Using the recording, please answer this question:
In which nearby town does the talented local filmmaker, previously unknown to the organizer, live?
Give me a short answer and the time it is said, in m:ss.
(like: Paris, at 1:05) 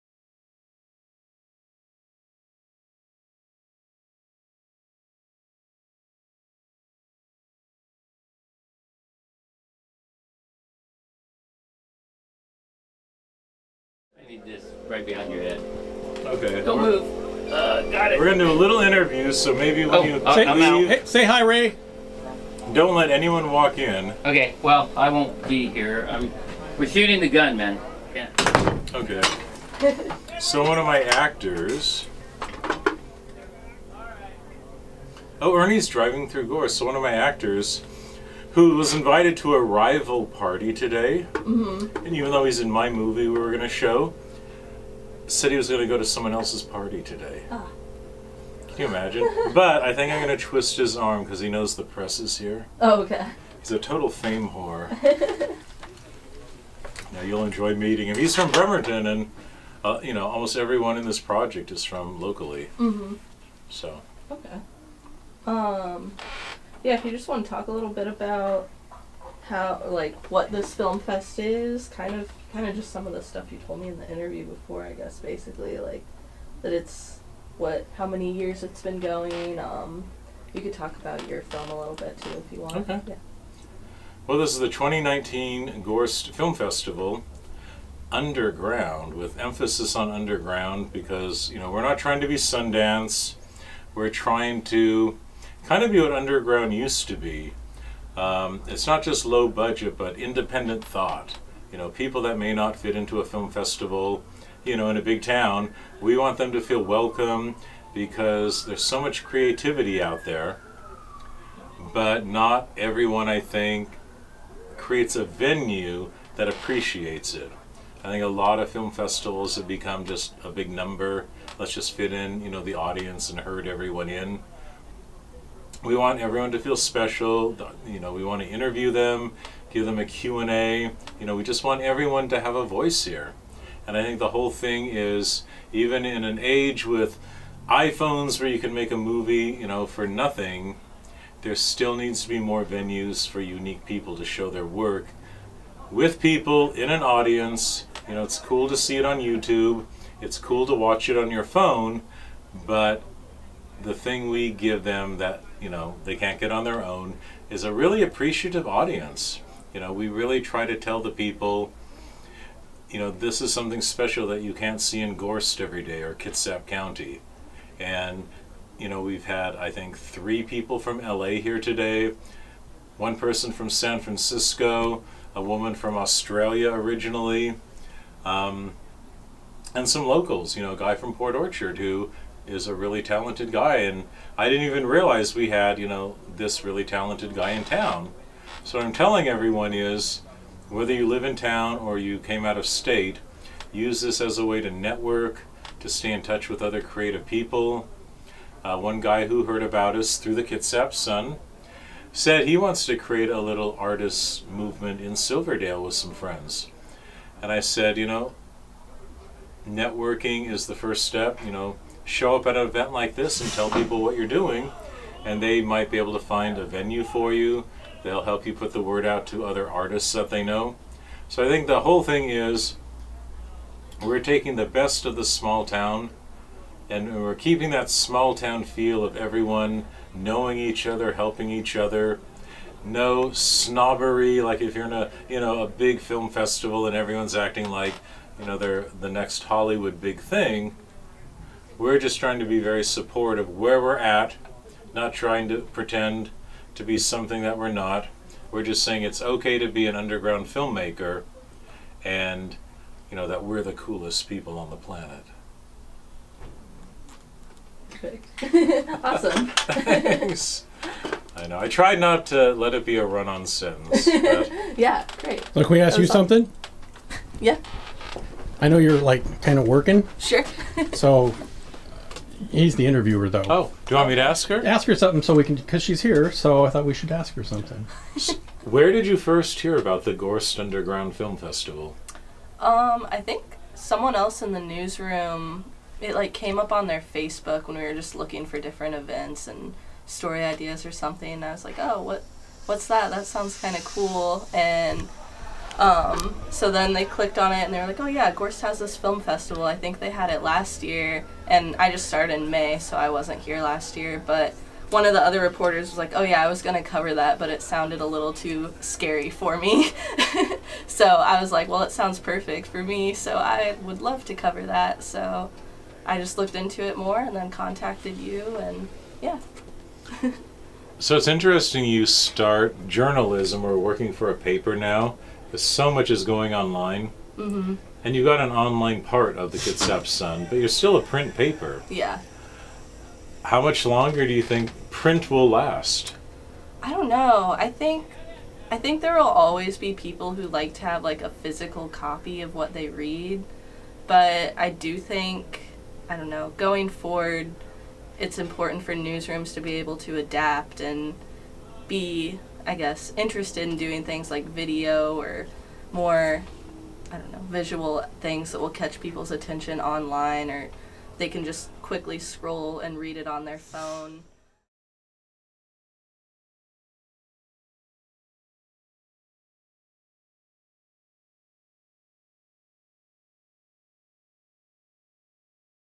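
Port Orchard, at 3:01.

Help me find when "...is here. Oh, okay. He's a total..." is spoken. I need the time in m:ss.
0:52.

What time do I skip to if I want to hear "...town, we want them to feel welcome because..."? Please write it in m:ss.
1:45.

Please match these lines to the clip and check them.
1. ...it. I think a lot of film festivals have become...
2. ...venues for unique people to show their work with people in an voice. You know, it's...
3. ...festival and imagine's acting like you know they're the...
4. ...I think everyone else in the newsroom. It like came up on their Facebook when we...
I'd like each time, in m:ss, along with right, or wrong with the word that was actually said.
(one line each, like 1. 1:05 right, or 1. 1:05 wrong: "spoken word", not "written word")
1. 1:57 right
2. 2:22 wrong: "audience", not "voice"
3. 3:56 wrong: "everyone", not "imagine"
4. 4:43 wrong: "someone", not "everyone".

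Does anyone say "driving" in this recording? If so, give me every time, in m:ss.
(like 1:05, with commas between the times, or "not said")
0:35.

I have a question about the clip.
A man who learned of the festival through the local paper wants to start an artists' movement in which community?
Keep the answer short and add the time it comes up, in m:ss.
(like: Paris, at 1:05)
Silverdale, at 3:25.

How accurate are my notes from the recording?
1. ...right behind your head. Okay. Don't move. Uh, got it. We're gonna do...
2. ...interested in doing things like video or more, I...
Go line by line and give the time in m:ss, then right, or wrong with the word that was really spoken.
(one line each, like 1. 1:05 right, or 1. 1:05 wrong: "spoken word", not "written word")
1. 0:14 right
2. 5:53 right.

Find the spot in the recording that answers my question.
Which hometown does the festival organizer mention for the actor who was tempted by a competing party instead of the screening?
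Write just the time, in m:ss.
0:58.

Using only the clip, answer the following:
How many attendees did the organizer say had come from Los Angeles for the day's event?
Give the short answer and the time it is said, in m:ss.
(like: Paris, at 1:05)
3, at 2:49.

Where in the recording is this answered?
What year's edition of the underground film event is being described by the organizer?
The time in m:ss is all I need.
1:24.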